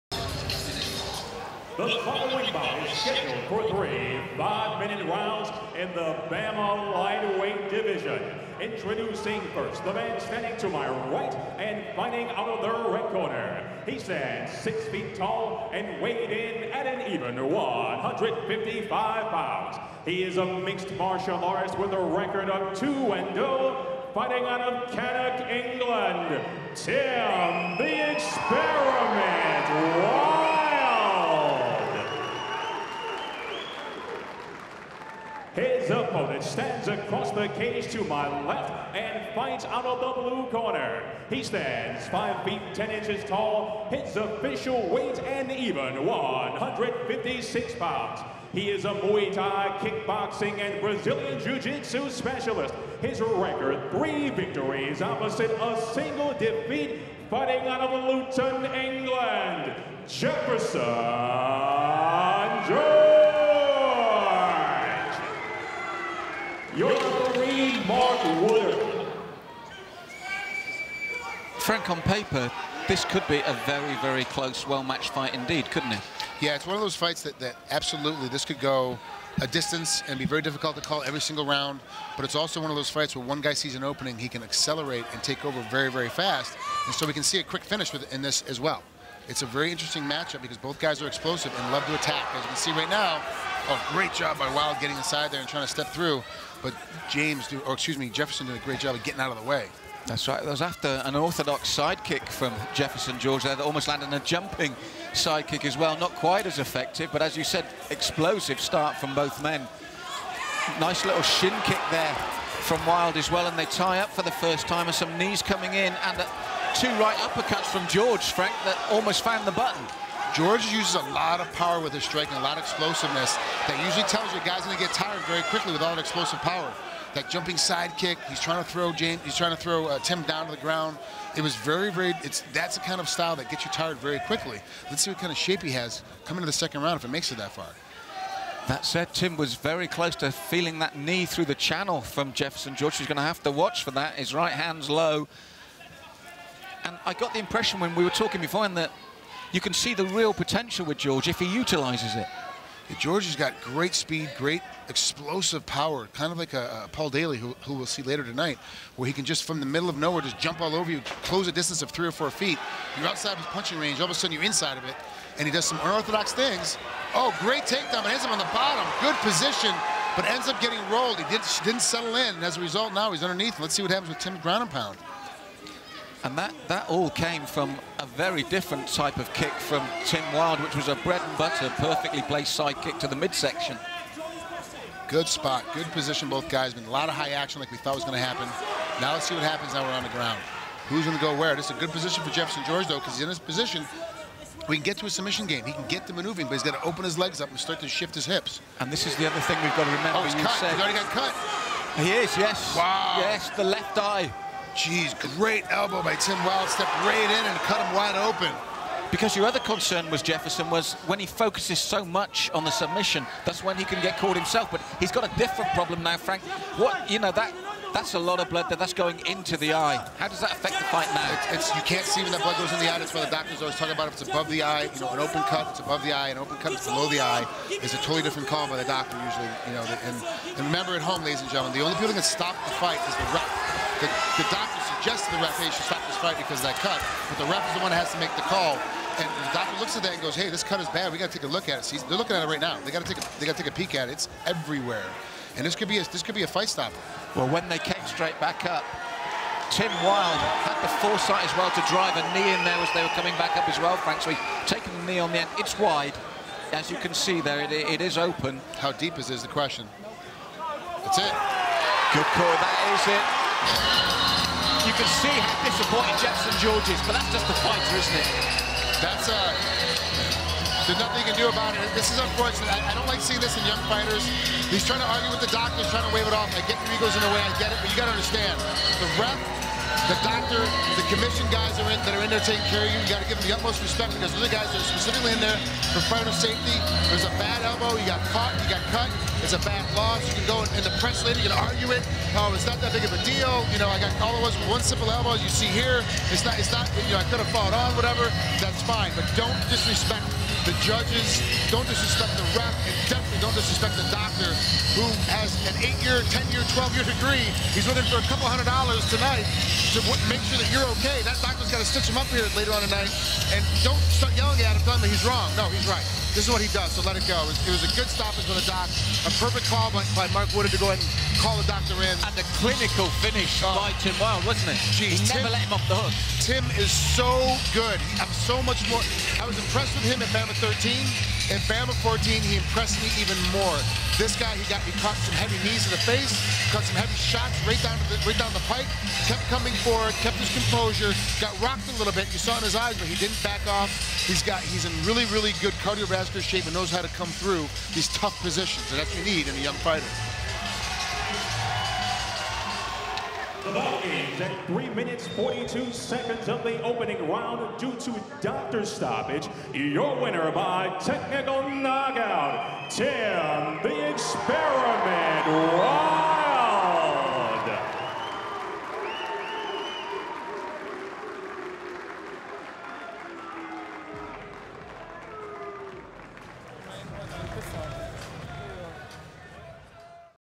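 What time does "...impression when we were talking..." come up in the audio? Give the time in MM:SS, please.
02:27.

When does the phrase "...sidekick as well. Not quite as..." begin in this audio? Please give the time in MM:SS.
01:45.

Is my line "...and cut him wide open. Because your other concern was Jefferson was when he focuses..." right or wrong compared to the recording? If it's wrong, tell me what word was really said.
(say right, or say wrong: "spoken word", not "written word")
right.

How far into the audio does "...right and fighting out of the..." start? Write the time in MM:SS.
00:11.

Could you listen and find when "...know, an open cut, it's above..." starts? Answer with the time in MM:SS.
03:45.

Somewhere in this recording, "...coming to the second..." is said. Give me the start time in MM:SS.
02:16.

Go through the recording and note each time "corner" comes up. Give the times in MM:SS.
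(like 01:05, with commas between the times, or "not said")
00:13, 00:40.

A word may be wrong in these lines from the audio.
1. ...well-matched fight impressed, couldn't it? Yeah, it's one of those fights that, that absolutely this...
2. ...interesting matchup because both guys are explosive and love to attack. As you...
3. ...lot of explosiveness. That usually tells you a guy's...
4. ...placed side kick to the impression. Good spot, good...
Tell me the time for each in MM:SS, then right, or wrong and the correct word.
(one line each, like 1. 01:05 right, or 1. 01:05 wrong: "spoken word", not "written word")
1. 01:14 wrong: "indeed", not "impressed"
2. 01:29 right
3. 02:02 right
4. 03:02 wrong: "midsection", not "impression".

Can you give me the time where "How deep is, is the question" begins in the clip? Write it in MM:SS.
04:18.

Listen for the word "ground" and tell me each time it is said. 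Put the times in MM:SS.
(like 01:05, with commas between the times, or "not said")
02:10, 02:54, 03:10.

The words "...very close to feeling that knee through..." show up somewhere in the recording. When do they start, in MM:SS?
02:19.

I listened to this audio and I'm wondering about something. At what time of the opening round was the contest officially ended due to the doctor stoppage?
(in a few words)
3:42.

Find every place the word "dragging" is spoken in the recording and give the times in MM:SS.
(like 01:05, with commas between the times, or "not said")
not said.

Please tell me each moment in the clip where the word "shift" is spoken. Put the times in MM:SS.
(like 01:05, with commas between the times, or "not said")
03:17.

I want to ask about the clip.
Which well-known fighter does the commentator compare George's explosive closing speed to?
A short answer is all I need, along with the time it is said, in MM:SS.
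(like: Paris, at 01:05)
Paul Daley, at 02:36.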